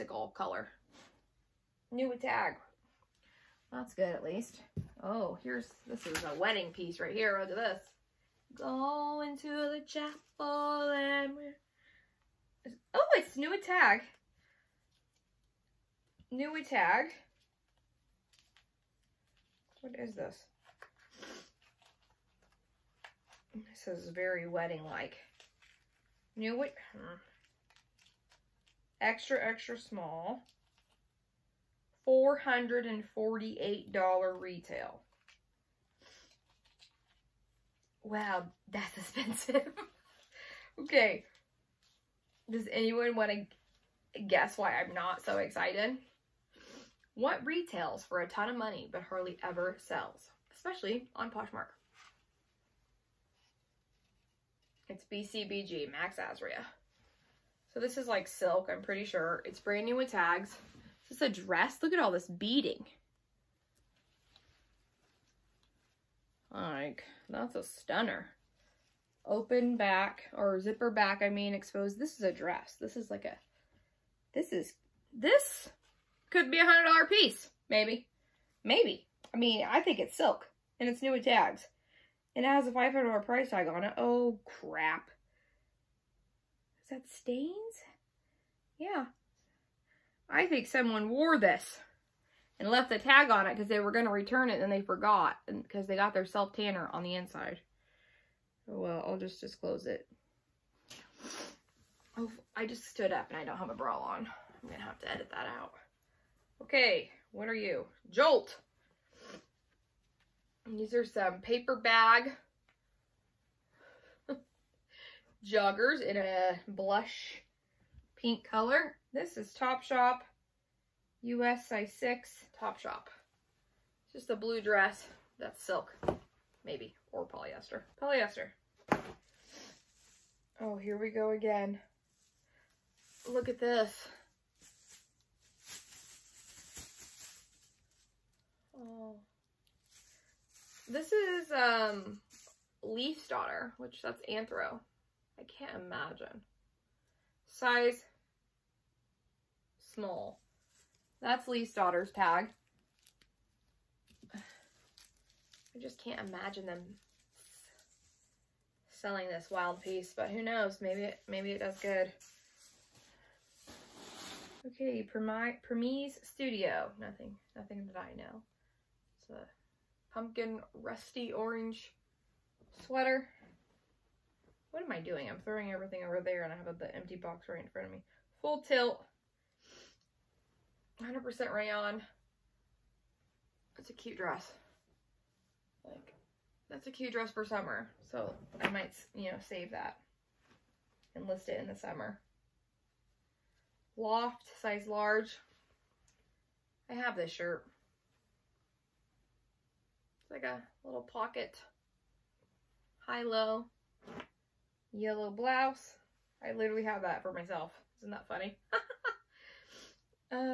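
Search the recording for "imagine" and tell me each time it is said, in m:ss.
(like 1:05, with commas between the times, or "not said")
2:25, 2:36.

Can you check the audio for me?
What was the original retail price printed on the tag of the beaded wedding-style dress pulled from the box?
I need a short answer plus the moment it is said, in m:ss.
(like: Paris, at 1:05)
$448, at 0:32.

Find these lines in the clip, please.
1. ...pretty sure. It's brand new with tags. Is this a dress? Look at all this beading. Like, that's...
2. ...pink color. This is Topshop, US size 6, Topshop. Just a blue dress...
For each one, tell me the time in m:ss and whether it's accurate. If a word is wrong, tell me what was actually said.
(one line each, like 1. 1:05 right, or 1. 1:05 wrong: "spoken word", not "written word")
1. 0:58 right
2. 1:58 right.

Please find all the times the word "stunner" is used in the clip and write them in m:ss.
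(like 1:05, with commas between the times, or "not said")
1:07.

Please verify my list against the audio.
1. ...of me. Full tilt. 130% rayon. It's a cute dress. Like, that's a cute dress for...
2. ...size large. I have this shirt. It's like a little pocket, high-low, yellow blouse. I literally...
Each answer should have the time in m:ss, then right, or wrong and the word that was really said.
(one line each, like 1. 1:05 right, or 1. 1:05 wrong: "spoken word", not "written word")
1. 2:57 wrong: "100", not "130"
2. 3:14 right.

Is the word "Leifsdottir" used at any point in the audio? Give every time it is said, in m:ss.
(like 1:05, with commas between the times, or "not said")
2:22, 2:31.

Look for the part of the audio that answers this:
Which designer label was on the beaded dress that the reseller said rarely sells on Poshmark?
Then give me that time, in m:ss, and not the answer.
0:55.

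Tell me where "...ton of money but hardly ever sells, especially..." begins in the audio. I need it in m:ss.
0:48.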